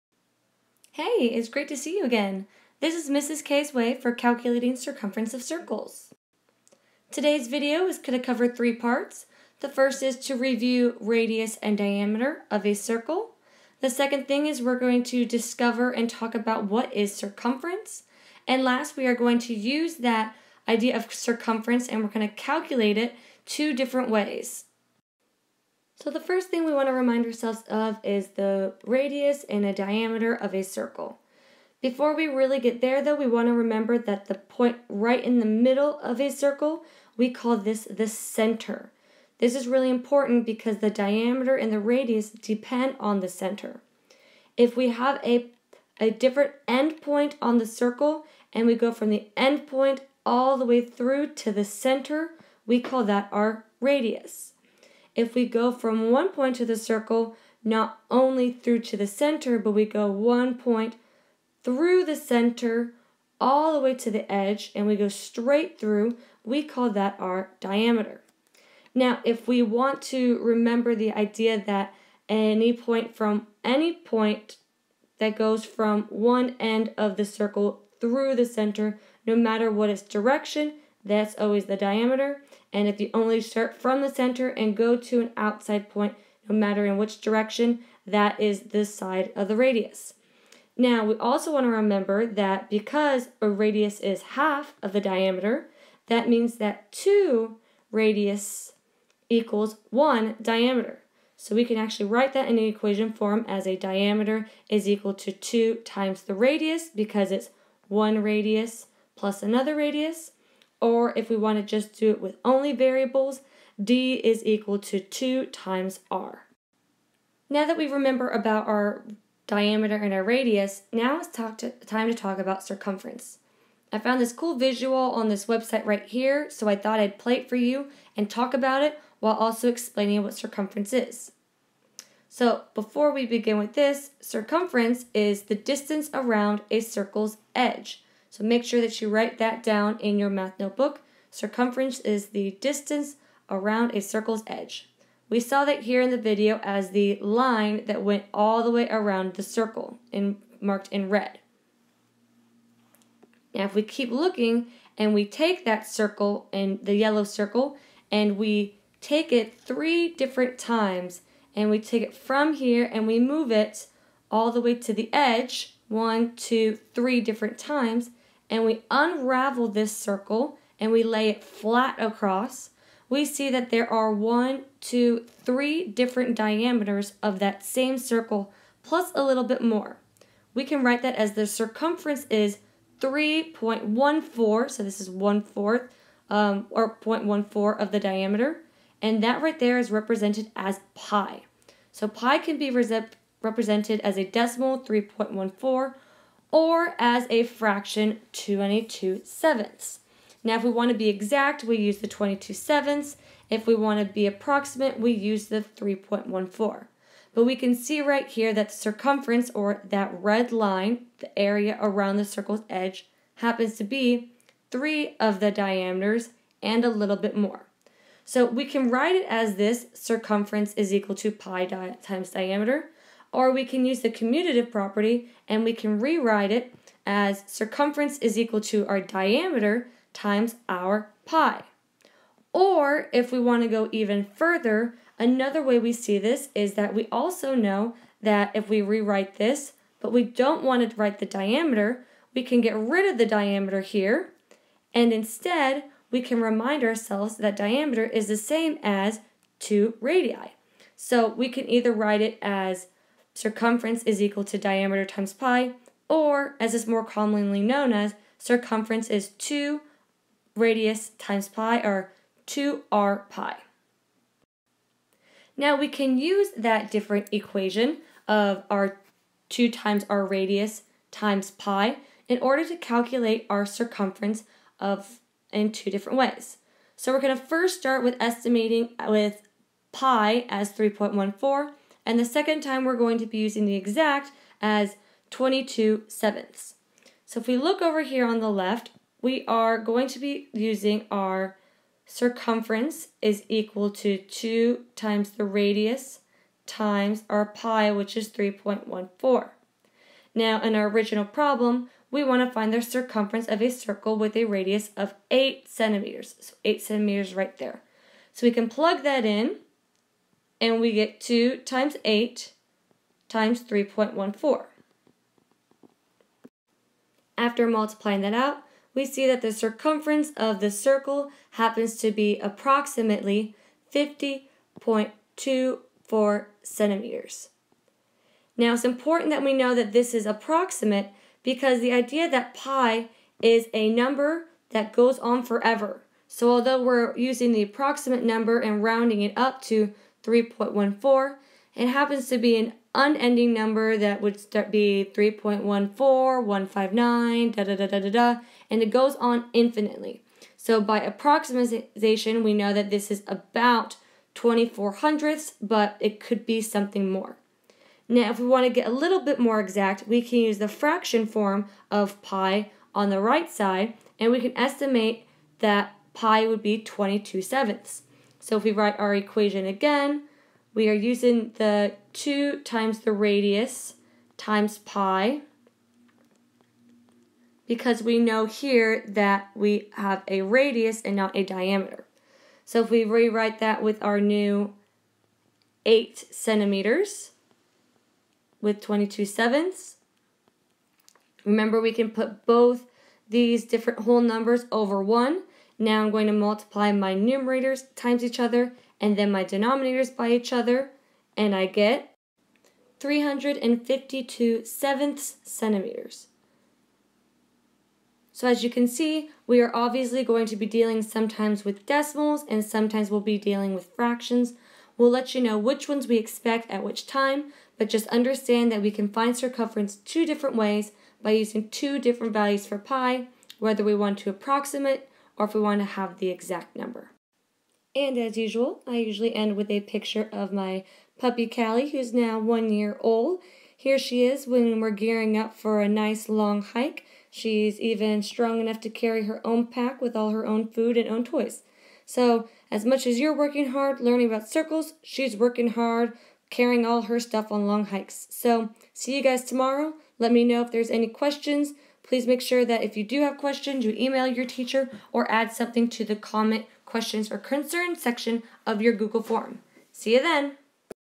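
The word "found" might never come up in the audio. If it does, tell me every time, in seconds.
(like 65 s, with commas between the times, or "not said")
123 s.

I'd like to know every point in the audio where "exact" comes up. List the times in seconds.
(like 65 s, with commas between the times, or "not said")
201 s, 283 s, 359 s, 426 s.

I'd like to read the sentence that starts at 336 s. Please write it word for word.
So although we're using the approximate number and rounding it up to 3.14.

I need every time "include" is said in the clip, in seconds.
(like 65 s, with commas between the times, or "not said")
not said.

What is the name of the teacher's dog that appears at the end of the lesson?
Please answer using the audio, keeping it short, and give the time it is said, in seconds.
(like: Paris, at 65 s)
Callie, at 431 s.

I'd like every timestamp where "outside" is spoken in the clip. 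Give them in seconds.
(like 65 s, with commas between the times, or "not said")
85 s.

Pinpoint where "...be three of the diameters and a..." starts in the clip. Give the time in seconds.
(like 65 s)
213 s.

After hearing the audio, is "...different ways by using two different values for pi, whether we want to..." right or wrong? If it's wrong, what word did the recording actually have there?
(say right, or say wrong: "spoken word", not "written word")
right.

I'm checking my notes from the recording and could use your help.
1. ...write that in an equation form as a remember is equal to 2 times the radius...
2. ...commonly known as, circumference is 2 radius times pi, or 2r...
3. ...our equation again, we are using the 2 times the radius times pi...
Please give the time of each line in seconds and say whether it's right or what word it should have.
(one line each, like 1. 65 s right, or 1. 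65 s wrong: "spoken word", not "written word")
1. 102 s wrong: "diameter", not "remember"
2. 257 s right
3. 368 s right.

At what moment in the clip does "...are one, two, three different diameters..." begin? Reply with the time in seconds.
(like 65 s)
173 s.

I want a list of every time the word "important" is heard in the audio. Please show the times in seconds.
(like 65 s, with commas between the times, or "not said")
39 s, 328 s.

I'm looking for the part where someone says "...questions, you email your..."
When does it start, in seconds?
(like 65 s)
453 s.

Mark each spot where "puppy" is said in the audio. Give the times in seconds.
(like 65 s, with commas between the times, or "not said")
431 s.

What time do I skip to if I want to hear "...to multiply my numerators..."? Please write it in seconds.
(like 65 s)
396 s.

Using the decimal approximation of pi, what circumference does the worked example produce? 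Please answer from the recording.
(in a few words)
50.24 centimeters.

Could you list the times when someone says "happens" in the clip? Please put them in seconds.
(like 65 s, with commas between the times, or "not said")
213 s, 321 s, 341 s.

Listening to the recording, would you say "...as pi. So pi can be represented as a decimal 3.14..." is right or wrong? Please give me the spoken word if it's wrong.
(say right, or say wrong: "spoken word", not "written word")
right.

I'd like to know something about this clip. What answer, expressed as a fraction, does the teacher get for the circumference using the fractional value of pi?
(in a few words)
352/7 centimeters.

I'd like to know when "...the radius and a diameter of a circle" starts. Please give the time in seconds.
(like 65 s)
28 s.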